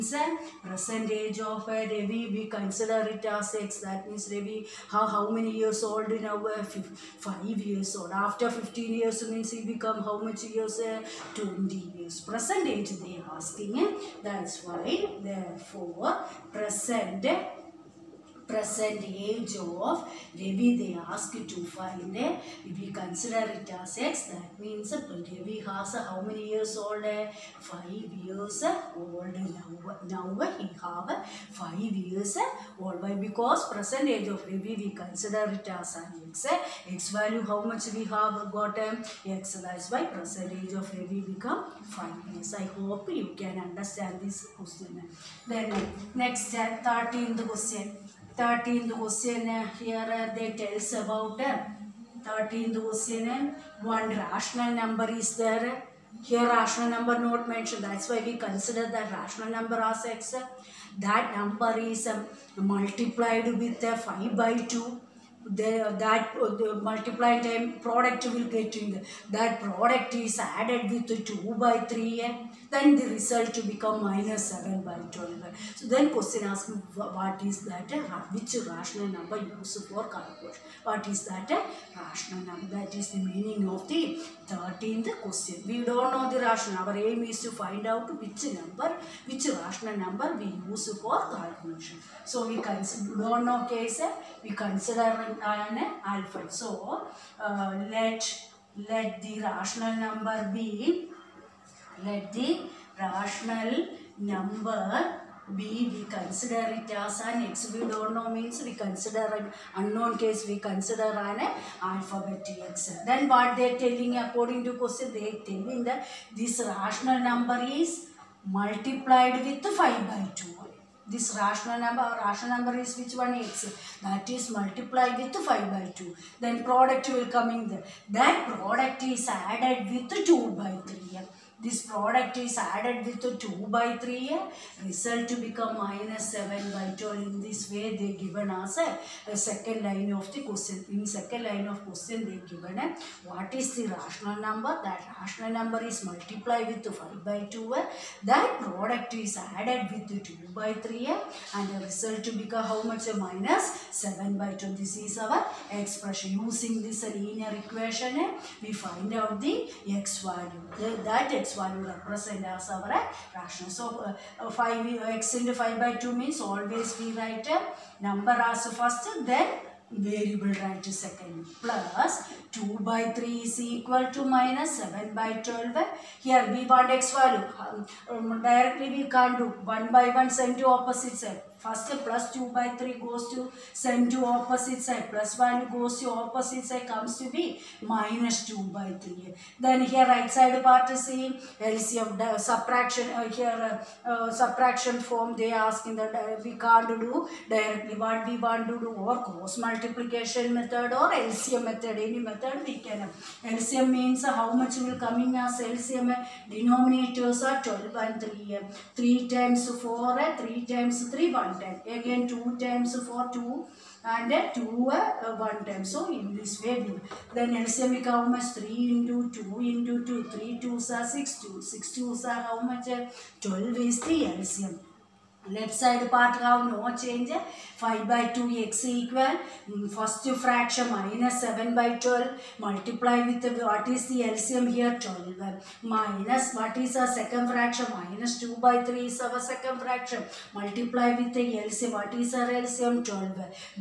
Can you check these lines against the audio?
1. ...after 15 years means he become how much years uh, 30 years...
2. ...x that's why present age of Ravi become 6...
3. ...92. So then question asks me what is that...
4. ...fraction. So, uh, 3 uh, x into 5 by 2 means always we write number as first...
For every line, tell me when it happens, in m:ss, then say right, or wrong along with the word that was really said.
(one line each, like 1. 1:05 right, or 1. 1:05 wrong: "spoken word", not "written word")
1. 0:08 wrong: "20", not "30"
2. 0:39 wrong: "5", not "6"
3. 1:15 wrong: "12", not "92"
4. 2:42 wrong: "5", not "3".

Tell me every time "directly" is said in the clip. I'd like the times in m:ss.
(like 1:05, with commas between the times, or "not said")
2:58, 3:17.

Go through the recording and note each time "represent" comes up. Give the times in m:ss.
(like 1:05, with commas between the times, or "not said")
2:41.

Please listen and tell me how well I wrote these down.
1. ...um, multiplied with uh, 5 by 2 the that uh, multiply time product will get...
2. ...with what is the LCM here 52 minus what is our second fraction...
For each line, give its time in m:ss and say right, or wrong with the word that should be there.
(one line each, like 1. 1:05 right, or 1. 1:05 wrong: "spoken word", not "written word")
1. 1:02 right
2. 3:53 wrong: "12", not "52".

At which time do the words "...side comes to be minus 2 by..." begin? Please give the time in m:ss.
3:06.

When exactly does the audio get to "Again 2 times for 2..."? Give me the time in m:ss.
3:31.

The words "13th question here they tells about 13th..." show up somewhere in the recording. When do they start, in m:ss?
0:48.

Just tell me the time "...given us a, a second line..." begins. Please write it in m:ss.
2:18.